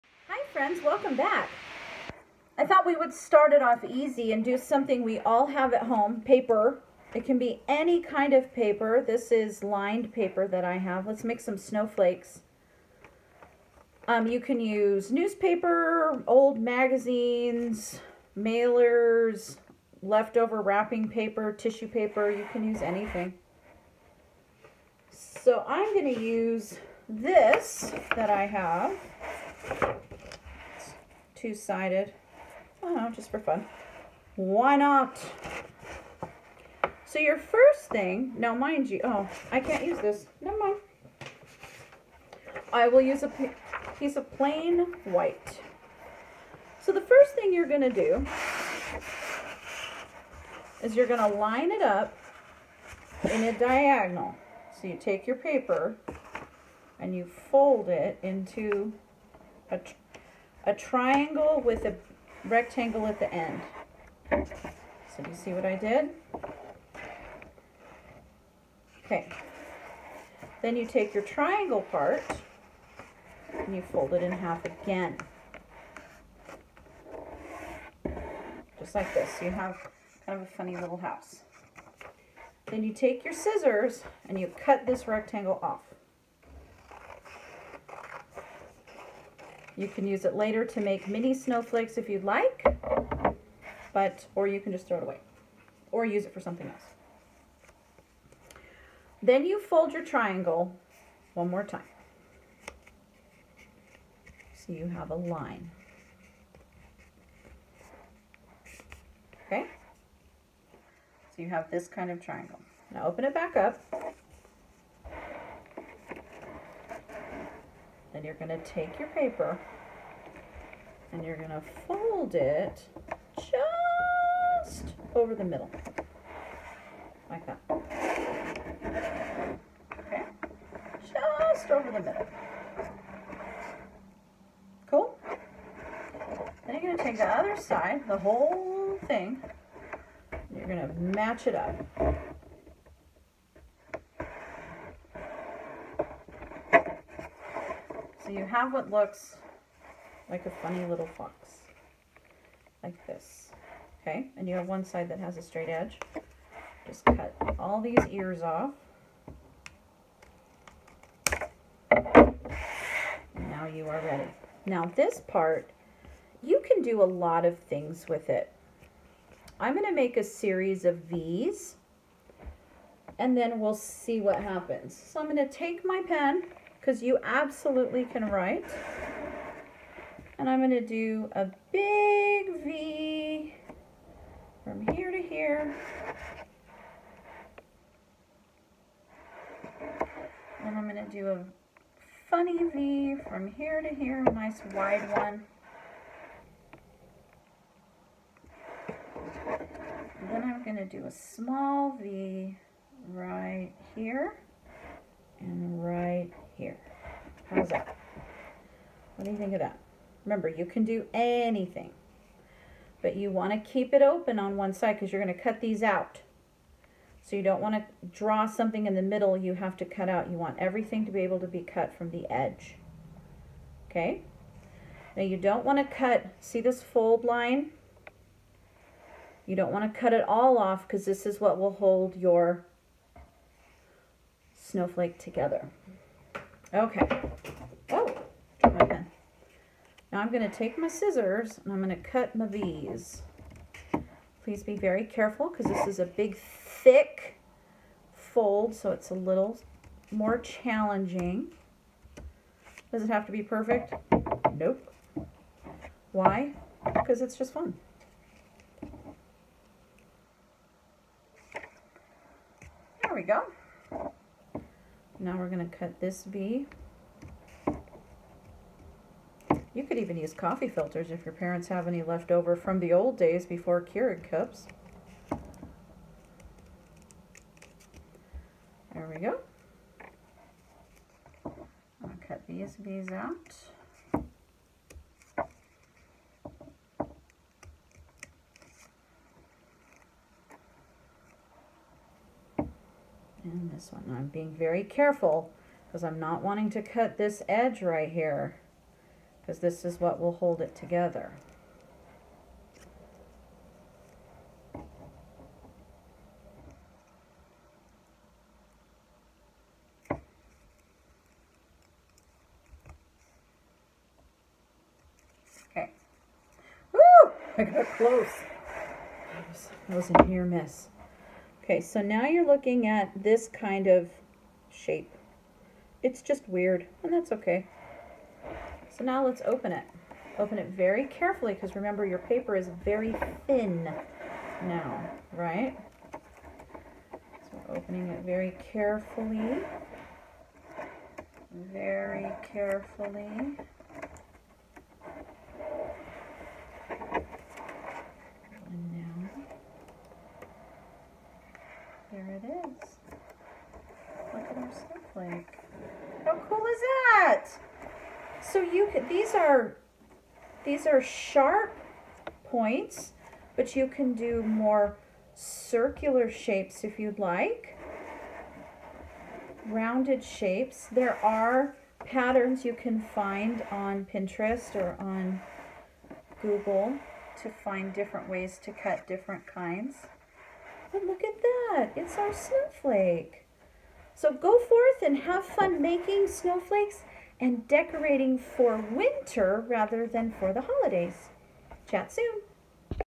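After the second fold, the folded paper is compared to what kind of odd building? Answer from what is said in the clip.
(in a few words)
funny little house.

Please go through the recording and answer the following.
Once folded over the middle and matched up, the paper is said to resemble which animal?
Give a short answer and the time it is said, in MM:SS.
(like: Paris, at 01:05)
fox, at 02:31.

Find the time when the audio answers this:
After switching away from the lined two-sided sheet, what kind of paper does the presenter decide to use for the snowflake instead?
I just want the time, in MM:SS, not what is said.
00:44.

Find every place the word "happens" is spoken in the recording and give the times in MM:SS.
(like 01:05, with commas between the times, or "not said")
02:54.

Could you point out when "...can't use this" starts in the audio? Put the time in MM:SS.
00:39.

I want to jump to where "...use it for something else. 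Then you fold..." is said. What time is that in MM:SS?
01:36.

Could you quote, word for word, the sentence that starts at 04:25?
Now we're going to cut this V.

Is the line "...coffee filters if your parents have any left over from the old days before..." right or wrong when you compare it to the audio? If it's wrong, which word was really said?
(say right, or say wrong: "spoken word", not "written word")
right.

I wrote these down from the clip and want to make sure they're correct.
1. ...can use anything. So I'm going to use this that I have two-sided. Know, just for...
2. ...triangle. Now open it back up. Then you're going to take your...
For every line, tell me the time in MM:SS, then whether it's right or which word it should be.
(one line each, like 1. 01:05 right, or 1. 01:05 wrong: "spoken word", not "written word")
1. 00:22 right
2. 01:52 right.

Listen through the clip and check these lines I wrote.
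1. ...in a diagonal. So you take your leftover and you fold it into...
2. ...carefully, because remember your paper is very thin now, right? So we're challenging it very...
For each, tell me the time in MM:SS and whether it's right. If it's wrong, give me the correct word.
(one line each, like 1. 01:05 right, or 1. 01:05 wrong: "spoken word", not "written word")
1. 00:53 wrong: "paper", not "leftover"
2. 05:31 wrong: "opening", not "challenging".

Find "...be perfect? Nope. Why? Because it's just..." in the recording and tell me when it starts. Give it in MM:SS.
04:13.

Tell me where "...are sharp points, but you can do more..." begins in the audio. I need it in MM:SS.
06:00.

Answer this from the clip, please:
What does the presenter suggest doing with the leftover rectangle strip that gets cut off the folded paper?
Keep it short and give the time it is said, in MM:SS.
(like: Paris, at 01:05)
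mini snowflakes, at 01:31.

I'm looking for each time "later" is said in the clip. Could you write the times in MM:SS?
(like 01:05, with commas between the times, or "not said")
01:30.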